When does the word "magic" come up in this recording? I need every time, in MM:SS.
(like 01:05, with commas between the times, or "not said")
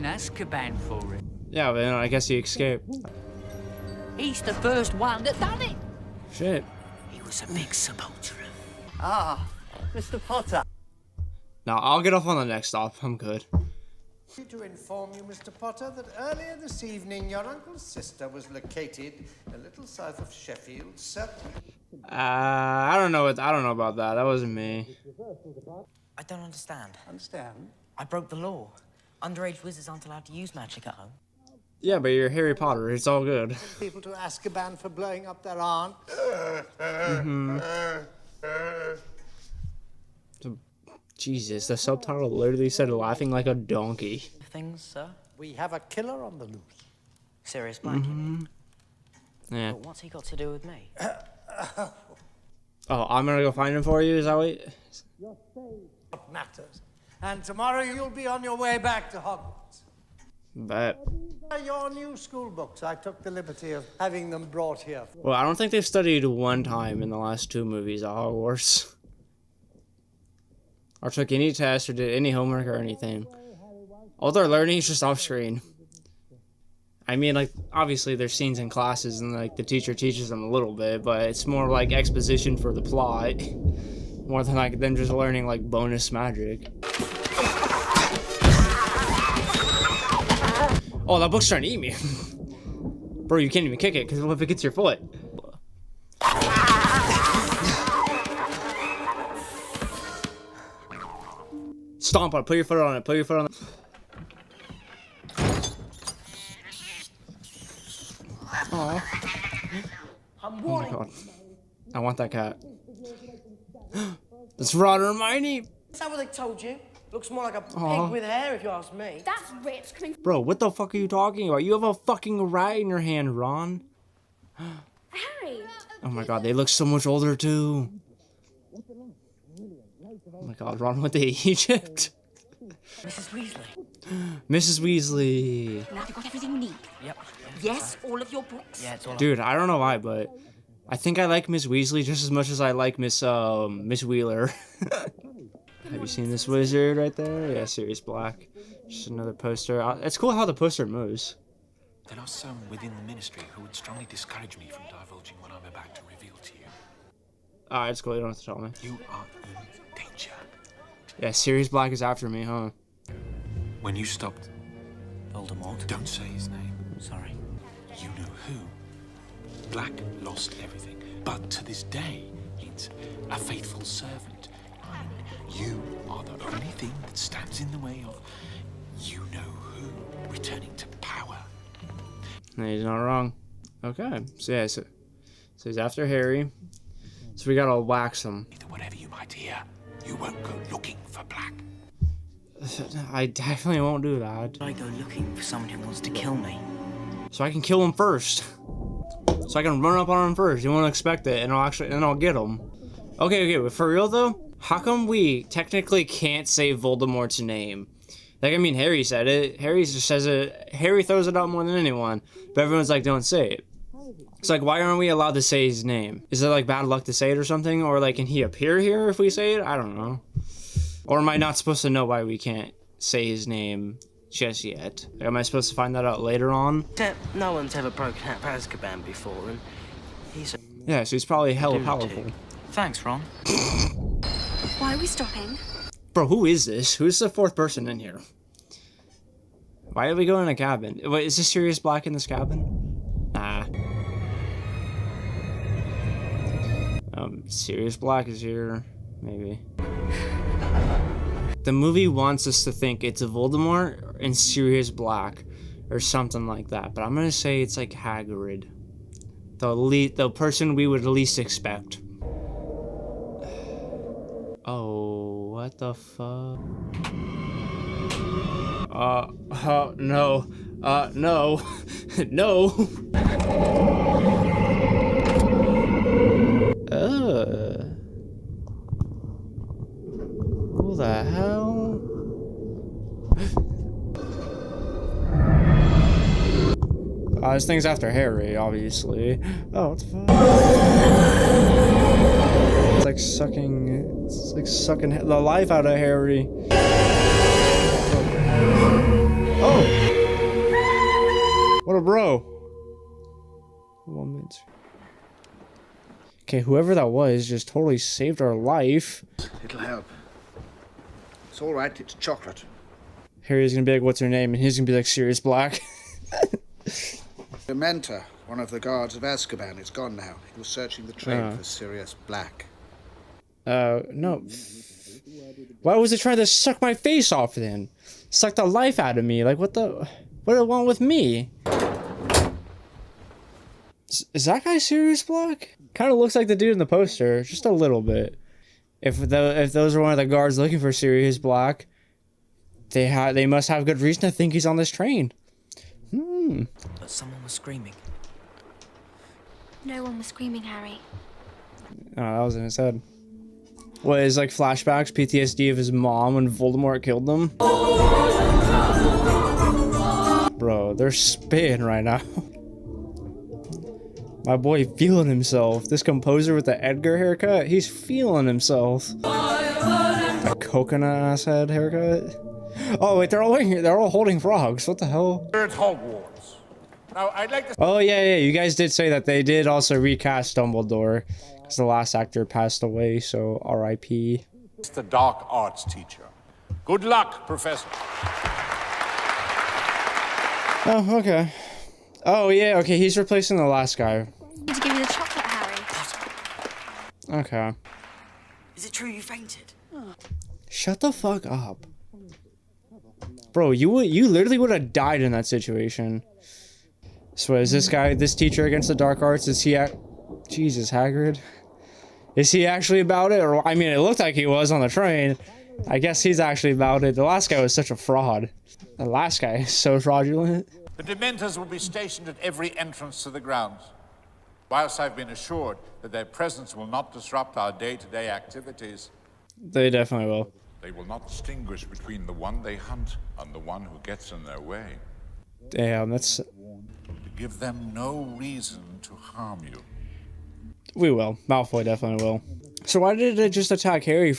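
00:30, 01:26.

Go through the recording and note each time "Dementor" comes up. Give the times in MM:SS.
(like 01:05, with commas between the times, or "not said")
05:17, 07:01.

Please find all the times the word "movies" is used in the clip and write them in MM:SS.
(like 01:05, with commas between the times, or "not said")
01:07, 04:11.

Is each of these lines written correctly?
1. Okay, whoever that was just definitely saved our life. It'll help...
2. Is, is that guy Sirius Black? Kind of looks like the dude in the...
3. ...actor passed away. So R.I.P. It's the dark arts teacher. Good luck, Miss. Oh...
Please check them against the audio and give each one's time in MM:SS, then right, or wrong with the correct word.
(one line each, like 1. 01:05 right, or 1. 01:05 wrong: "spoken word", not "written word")
1. 05:06 wrong: "totally", not "definitely"
2. 05:34 right
3. 06:22 wrong: "Professor", not "Miss".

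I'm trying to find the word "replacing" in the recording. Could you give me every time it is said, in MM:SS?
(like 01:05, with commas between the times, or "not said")
06:33.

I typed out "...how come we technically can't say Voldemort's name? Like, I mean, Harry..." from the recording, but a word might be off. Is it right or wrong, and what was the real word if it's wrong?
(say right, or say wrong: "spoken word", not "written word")
right.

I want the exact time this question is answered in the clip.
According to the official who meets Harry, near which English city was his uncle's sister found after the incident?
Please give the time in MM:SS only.
00:20.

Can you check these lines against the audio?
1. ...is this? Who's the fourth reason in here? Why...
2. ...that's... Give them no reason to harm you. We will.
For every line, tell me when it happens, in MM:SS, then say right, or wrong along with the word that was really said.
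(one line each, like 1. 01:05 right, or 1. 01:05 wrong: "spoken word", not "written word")
1. 03:56 wrong: "person", not "reason"
2. 07:16 right.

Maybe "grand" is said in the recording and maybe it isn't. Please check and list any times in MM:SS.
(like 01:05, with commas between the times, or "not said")
not said.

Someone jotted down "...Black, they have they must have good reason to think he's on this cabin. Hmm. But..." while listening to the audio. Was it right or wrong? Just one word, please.
wrong.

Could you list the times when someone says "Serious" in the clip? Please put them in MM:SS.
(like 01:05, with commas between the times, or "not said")
00:47.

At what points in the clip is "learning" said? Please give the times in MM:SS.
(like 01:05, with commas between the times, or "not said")
01:14, 01:25.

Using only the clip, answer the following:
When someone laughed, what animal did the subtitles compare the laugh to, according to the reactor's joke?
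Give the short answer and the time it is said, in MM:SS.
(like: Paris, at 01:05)
Donkey, at 00:43.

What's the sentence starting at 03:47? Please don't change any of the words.
No one's ever broken out of Azkaban before, and he's...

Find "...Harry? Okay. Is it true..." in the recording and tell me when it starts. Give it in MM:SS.
06:35.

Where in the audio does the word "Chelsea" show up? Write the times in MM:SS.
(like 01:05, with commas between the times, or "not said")
not said.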